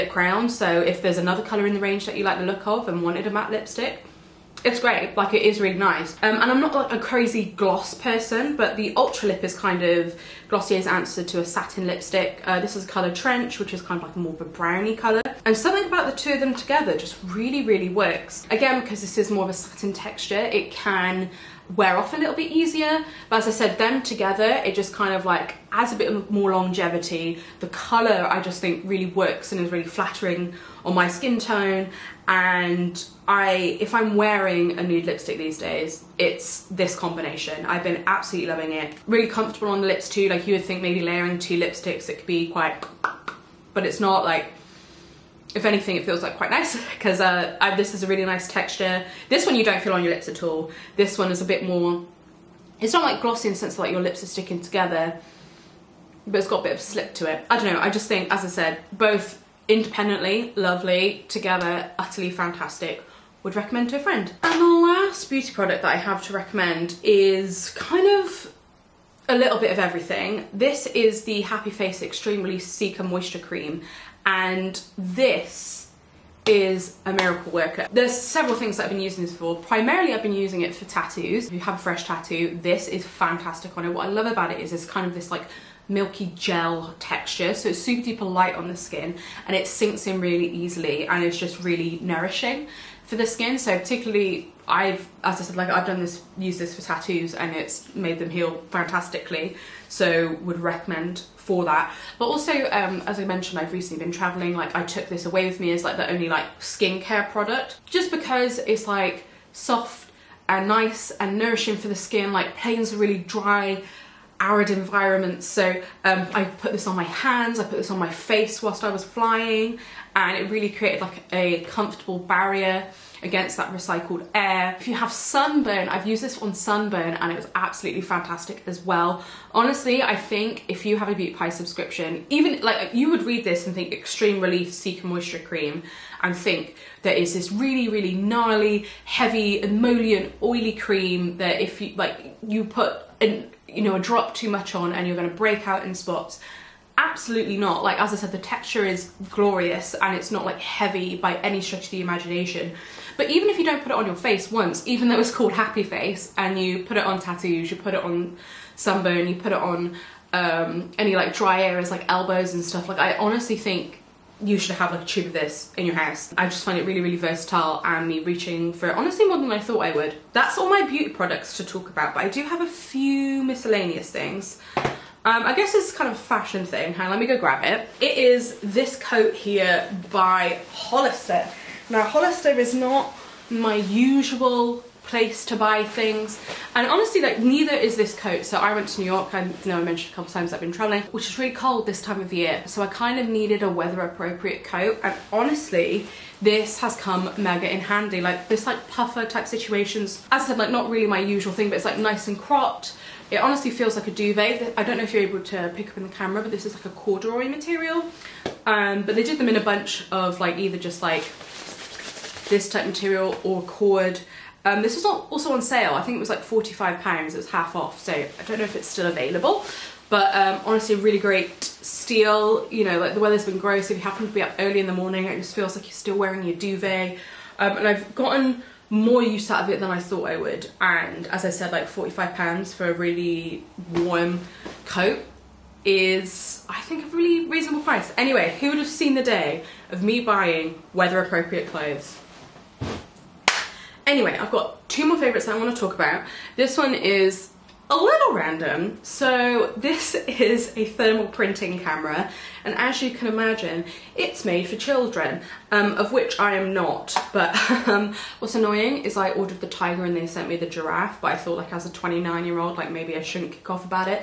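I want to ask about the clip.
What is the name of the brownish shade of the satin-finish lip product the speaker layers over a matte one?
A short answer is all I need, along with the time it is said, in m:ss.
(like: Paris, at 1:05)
Trench, at 0:13.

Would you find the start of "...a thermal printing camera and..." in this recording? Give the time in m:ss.
4:10.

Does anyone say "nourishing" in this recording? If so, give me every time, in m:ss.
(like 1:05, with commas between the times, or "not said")
1:32, 1:51.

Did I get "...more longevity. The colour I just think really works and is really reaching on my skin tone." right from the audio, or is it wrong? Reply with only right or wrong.
wrong.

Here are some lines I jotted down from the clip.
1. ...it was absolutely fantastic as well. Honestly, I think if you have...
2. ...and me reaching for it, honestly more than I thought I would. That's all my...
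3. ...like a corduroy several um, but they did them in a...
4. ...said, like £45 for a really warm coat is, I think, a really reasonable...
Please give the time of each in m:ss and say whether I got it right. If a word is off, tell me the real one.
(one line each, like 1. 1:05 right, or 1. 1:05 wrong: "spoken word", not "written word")
1. 2:07 right
2. 2:47 right
3. 3:26 wrong: "material", not "several"
4. 3:51 right.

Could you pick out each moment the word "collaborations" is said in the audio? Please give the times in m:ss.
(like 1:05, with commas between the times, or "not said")
not said.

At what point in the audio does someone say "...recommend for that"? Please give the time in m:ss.
1:40.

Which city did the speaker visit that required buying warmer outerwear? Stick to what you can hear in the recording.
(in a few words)
New York.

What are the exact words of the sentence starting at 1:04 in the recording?
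And the last beauty product that I have to recommend is kind of a little bit of everything.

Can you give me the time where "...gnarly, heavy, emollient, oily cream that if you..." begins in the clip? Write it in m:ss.
2:18.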